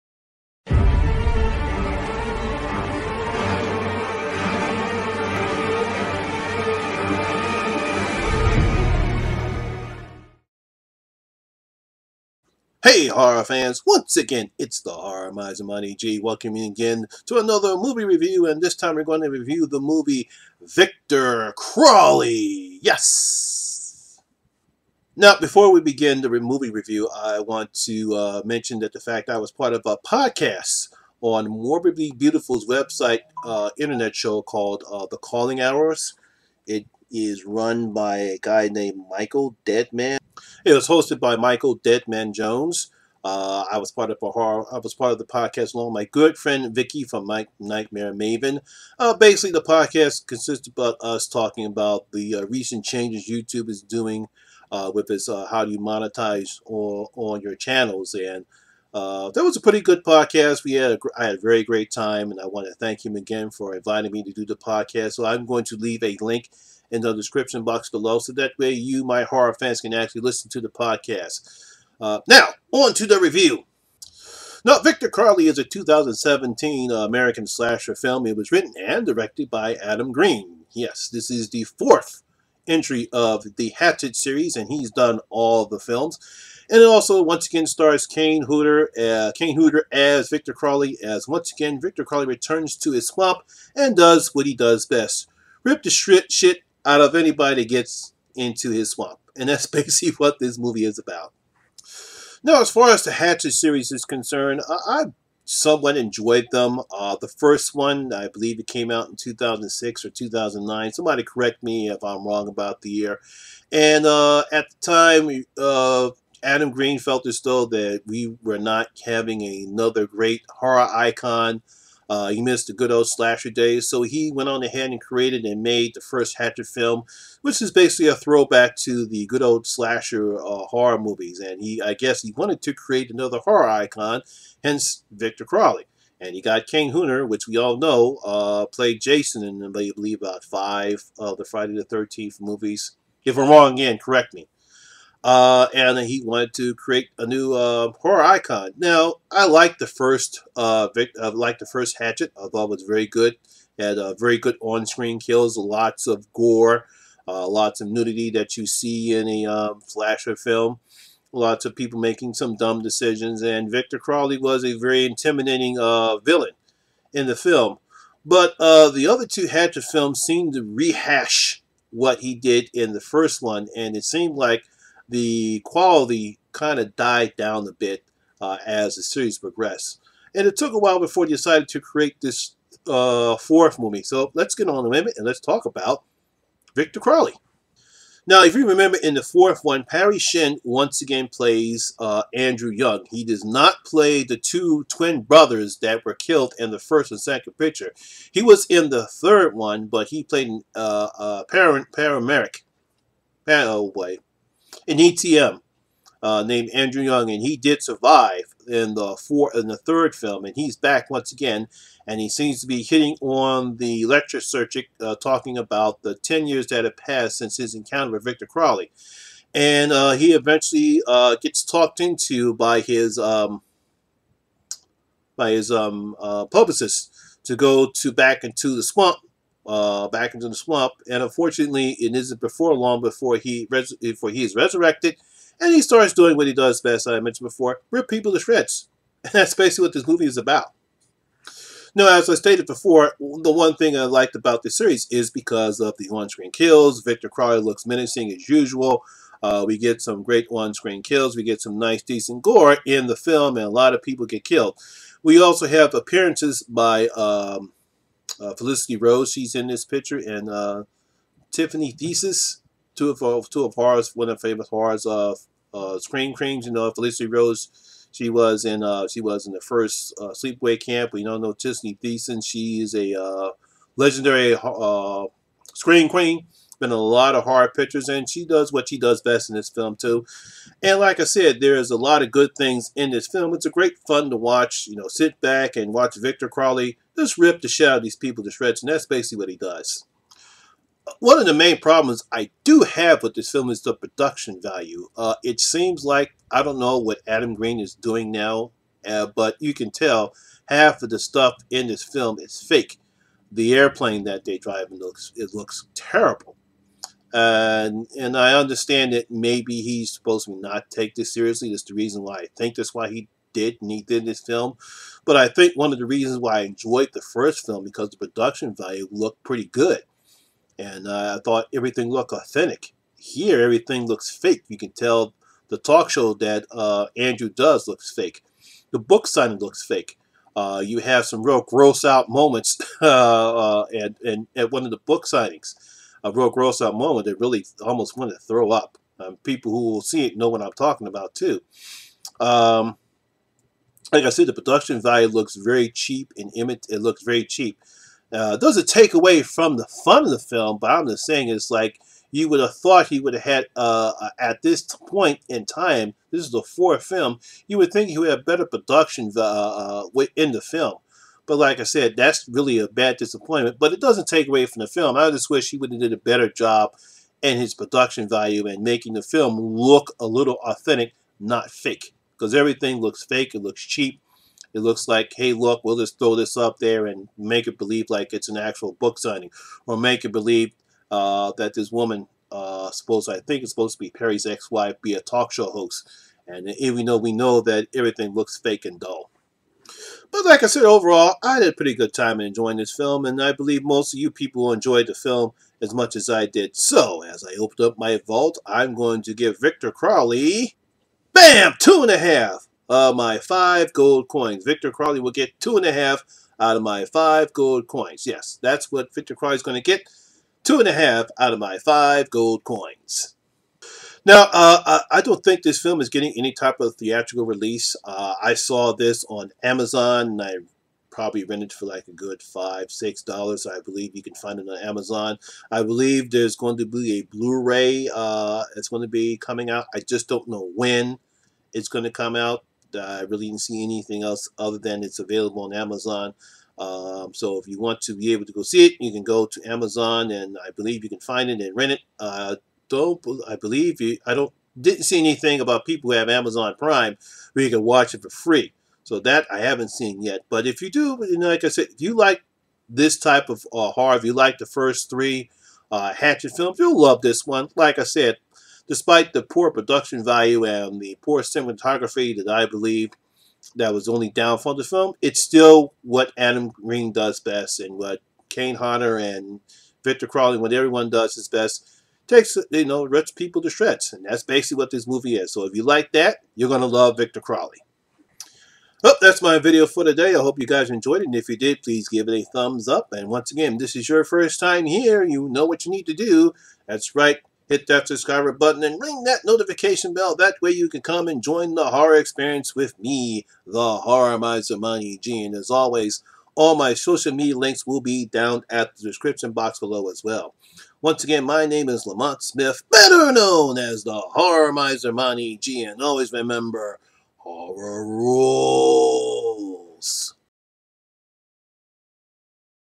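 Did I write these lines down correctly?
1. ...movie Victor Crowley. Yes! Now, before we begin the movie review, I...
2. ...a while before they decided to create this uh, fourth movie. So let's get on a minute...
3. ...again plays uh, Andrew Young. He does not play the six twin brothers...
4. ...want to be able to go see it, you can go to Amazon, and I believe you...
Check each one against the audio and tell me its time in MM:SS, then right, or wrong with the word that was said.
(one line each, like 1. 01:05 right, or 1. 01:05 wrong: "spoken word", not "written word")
1. 00:19 right
2. 03:00 right
3. 03:11 wrong: "two", not "six"
4. 07:17 right.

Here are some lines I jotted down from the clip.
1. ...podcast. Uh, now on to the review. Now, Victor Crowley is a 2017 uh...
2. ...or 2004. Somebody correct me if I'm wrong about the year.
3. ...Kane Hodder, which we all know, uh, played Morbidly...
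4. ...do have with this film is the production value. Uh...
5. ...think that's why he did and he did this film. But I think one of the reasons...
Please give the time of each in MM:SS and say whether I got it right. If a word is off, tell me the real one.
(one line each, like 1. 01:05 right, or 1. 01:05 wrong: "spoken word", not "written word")
1. 01:10 right
2. 01:50 wrong: "2009", not "2004"
3. 02:16 wrong: "Jason", not "Morbidly"
4. 04:52 right
5. 05:12 right.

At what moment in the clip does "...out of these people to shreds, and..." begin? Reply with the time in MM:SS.
04:47.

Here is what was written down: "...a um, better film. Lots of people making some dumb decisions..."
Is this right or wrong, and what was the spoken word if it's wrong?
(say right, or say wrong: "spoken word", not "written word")
wrong: "slasher", not "better".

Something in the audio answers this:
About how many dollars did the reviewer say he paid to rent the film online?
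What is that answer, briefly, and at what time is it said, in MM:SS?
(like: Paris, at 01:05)
5 or 6 dollars, at 07:02.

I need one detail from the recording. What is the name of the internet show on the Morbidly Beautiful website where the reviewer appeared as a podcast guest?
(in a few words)
The Calling Hours.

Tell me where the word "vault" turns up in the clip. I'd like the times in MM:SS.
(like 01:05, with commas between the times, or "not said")
06:38.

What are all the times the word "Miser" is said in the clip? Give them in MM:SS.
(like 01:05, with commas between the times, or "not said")
00:15, 08:14, 08:24.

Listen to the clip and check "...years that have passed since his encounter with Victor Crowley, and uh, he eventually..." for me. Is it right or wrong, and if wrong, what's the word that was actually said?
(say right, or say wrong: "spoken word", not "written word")
right.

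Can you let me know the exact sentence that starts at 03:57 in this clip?
I mentioned before, rip people to shreds.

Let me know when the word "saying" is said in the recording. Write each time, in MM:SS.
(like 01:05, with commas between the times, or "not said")
05:51.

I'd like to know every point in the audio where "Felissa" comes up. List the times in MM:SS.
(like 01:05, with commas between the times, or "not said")
04:18, 04:26.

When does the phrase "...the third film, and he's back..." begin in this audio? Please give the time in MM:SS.
03:29.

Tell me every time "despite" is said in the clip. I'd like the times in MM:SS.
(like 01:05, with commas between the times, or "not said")
07:38.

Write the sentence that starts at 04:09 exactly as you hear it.
Uh, we get some great on-screen kills.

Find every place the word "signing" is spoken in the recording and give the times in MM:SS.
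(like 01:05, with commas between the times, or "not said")
05:29, 05:35, 06:19.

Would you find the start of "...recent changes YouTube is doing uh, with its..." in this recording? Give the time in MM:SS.
00:52.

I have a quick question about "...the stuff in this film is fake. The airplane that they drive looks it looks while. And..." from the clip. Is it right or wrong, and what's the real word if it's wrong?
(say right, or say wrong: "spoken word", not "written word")
wrong: "terrible", not "while".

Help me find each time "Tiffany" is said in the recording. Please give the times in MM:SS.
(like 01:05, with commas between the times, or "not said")
04:21, 04:31.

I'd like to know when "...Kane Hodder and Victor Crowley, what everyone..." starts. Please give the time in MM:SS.
07:48.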